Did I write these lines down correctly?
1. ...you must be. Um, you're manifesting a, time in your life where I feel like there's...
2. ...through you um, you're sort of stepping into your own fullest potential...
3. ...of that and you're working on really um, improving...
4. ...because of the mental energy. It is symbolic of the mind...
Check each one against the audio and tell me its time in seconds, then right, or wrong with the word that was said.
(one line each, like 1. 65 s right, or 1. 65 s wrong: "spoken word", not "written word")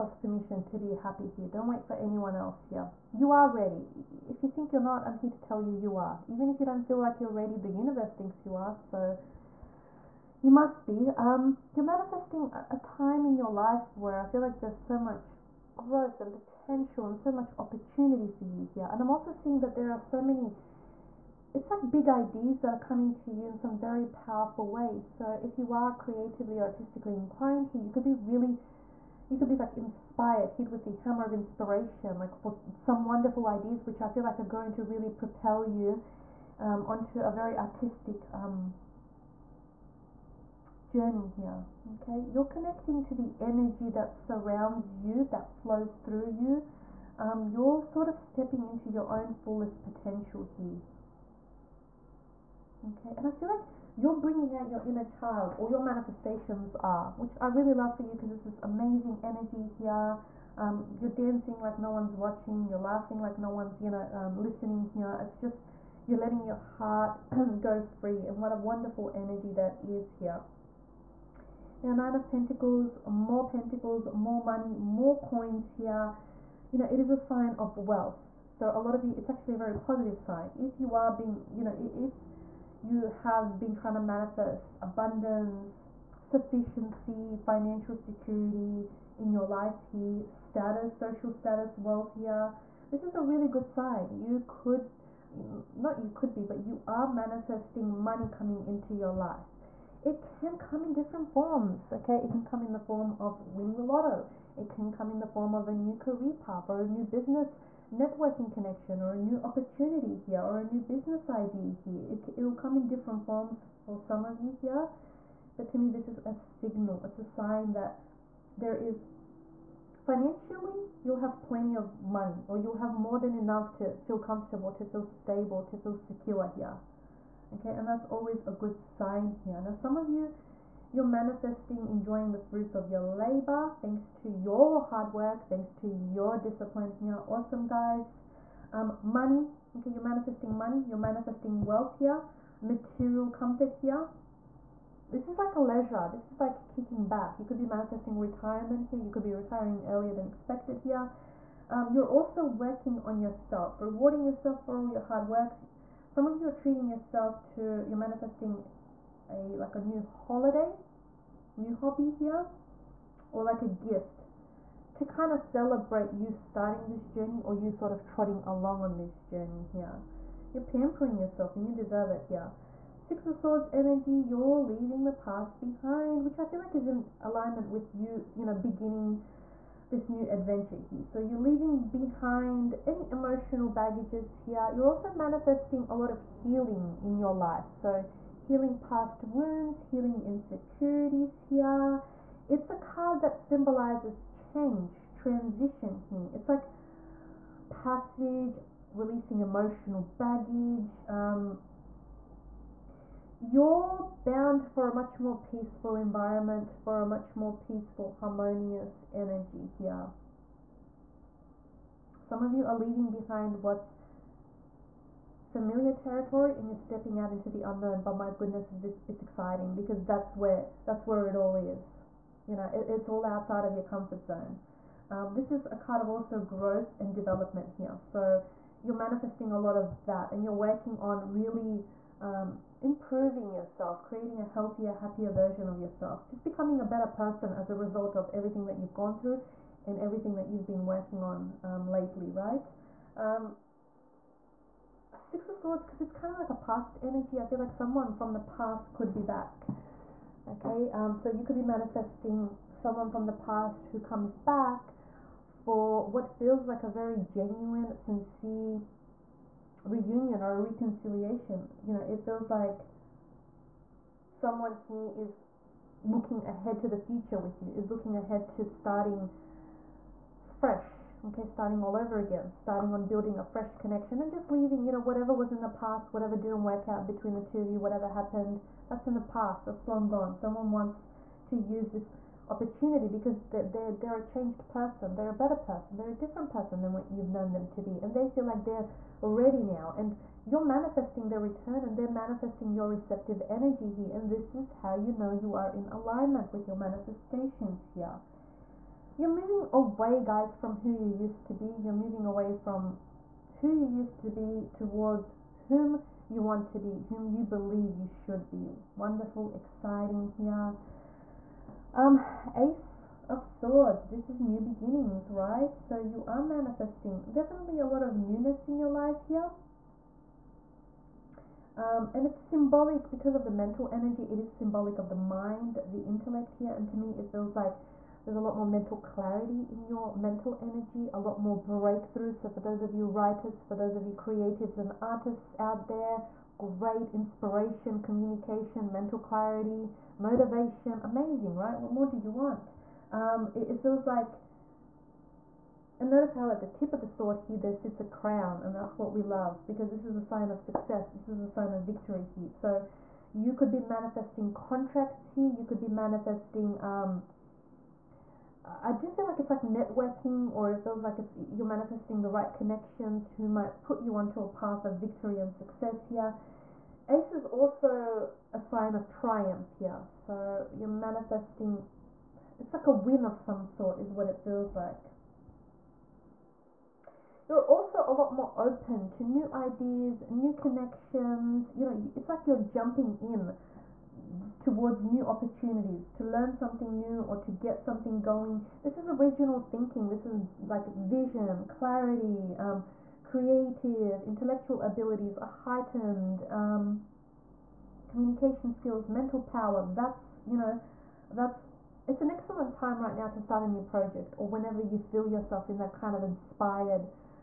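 1. 10 s right
2. 46 s right
3. 229 s right
4. 323 s right.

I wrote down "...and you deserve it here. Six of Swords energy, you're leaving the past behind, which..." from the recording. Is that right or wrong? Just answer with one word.
right.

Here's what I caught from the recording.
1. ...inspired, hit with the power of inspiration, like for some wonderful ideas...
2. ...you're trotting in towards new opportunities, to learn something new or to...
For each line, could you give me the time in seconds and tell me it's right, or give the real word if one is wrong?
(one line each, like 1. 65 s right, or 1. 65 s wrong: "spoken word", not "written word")
1. 29 s wrong: "hammer", not "power"
2. 382 s wrong: "jumping", not "trotting".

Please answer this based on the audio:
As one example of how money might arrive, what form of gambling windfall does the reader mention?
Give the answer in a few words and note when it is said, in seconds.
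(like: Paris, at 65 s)
winning the lotto, at 103 s.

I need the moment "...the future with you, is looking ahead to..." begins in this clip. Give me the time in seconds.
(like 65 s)
266 s.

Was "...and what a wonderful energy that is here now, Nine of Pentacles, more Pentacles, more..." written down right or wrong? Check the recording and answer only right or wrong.
right.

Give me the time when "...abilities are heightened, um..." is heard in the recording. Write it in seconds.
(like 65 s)
394 s.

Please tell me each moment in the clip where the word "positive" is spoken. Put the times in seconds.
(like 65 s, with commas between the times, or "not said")
79 s.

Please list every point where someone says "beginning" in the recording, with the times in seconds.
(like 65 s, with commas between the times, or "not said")
178 s, 314 s.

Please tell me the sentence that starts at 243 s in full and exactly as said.
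Um, Six of Swords, because it's kind of like a past energy.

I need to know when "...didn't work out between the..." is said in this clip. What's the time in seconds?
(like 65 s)
276 s.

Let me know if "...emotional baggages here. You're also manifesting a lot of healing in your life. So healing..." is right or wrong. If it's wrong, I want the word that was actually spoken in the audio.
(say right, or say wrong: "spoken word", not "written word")
right.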